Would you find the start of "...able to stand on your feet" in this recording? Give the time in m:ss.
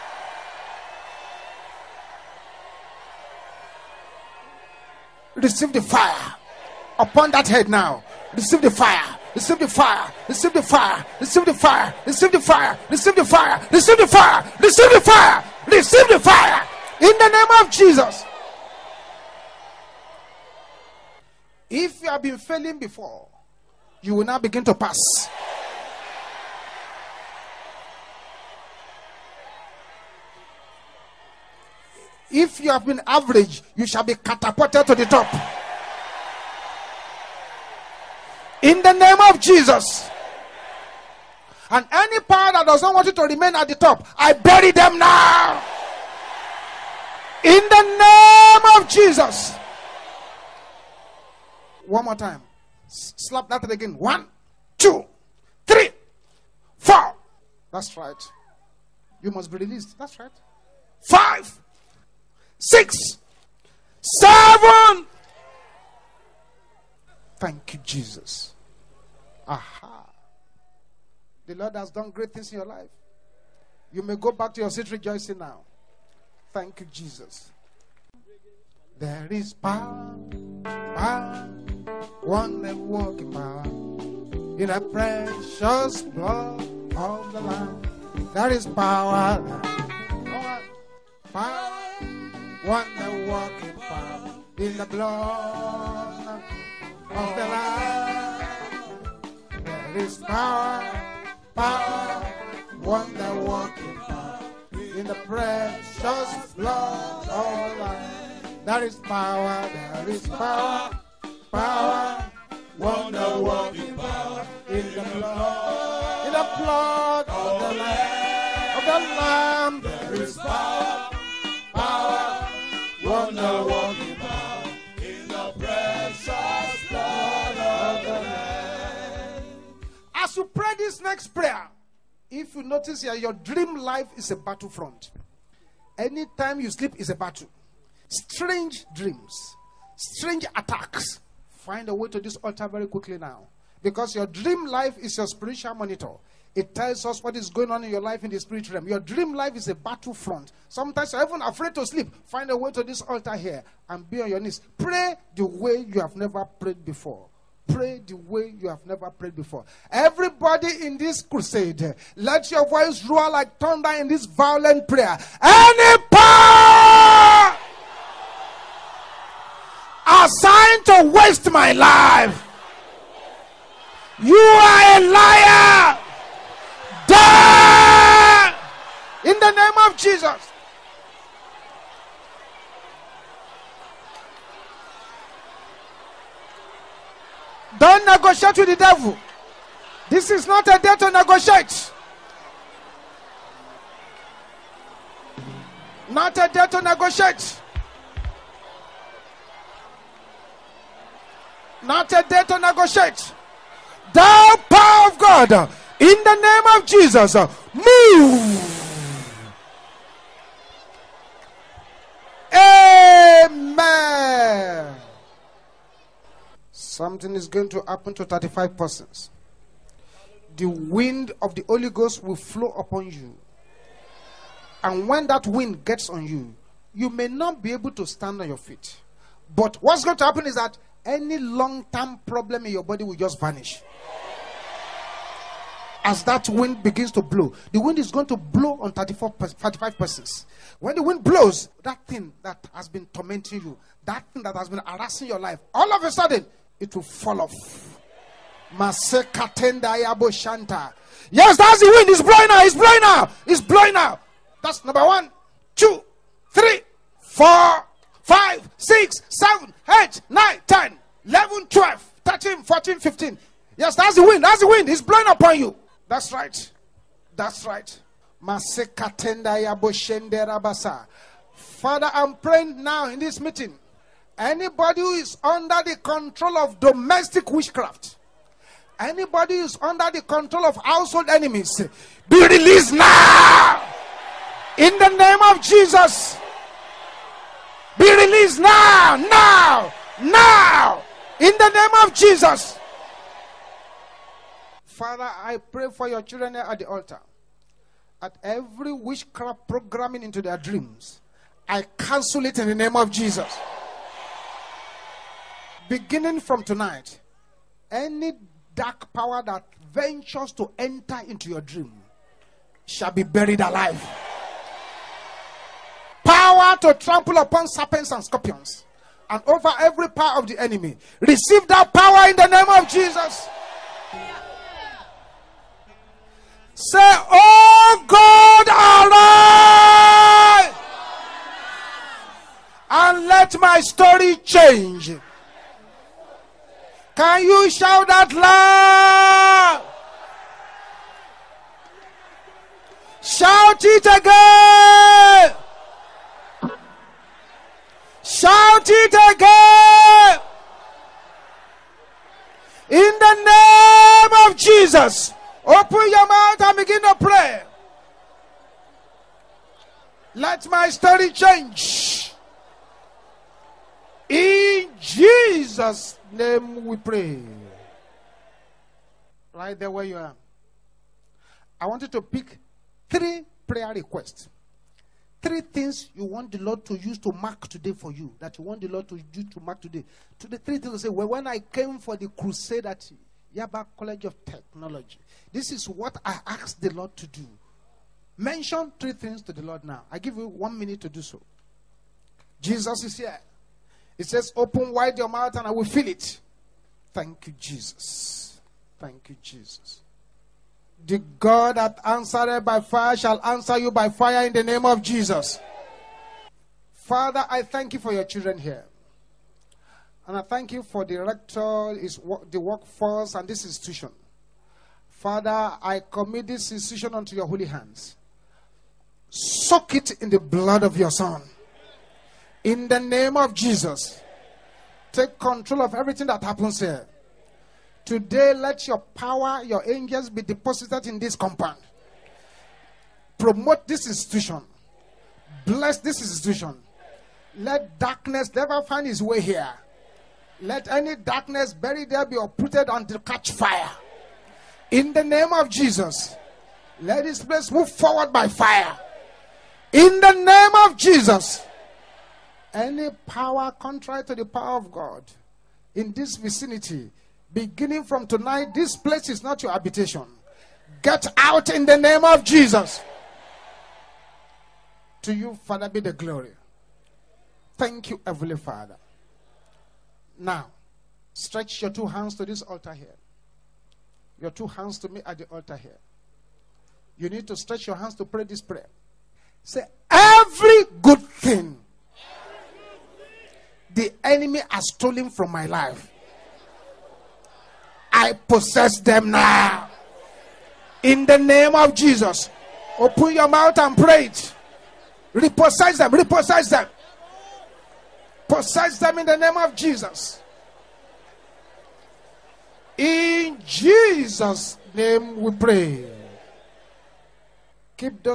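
3:47.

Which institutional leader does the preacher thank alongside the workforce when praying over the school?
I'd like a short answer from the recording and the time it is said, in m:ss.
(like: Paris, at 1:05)
The rector, at 6:51.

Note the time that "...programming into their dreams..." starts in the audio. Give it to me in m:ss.
4:59.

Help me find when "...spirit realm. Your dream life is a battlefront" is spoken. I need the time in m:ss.
2:28.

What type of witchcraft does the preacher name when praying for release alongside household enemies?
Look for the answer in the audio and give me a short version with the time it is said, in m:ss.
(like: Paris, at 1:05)
Domestic witchcraft, at 4:36.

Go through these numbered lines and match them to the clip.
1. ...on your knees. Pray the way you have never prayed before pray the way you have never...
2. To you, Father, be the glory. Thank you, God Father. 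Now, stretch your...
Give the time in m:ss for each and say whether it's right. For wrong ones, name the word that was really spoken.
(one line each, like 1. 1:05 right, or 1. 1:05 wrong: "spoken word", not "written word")
1. 2:34 right
2. 7:45 wrong: "Heavenly", not "God".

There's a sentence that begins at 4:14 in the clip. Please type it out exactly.
That's number one, two, three, four, five, six, seven, eight, nine, ten, eleven, twelve, thirteen, fourteen, fifteen.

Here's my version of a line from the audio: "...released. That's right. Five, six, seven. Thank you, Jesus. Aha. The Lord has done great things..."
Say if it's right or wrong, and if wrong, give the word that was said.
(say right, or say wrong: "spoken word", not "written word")
right.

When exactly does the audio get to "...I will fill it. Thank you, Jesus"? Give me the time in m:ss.
6:35.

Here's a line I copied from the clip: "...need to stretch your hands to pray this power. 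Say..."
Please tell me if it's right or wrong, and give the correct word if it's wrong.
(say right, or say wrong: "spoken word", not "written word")
wrong: "prayer", not "power".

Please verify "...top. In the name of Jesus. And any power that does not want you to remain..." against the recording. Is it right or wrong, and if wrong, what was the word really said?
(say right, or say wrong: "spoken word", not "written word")
right.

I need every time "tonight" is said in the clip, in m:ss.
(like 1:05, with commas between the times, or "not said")
5:06, 7:38.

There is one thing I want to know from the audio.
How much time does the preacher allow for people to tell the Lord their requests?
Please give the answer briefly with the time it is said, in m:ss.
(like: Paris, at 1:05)
One minute, at 6:30.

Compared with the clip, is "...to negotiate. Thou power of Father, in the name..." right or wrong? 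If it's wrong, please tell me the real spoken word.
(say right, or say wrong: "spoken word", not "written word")
wrong: "God", not "Father".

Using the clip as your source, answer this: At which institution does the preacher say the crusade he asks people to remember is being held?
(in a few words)
Yaba College of Technology.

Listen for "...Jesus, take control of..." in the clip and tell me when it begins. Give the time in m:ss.
7:03.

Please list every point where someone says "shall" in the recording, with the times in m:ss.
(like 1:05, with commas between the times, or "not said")
0:33, 5:12, 6:43.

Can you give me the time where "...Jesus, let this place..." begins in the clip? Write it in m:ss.
7:25.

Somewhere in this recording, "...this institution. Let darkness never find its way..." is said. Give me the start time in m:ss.
7:15.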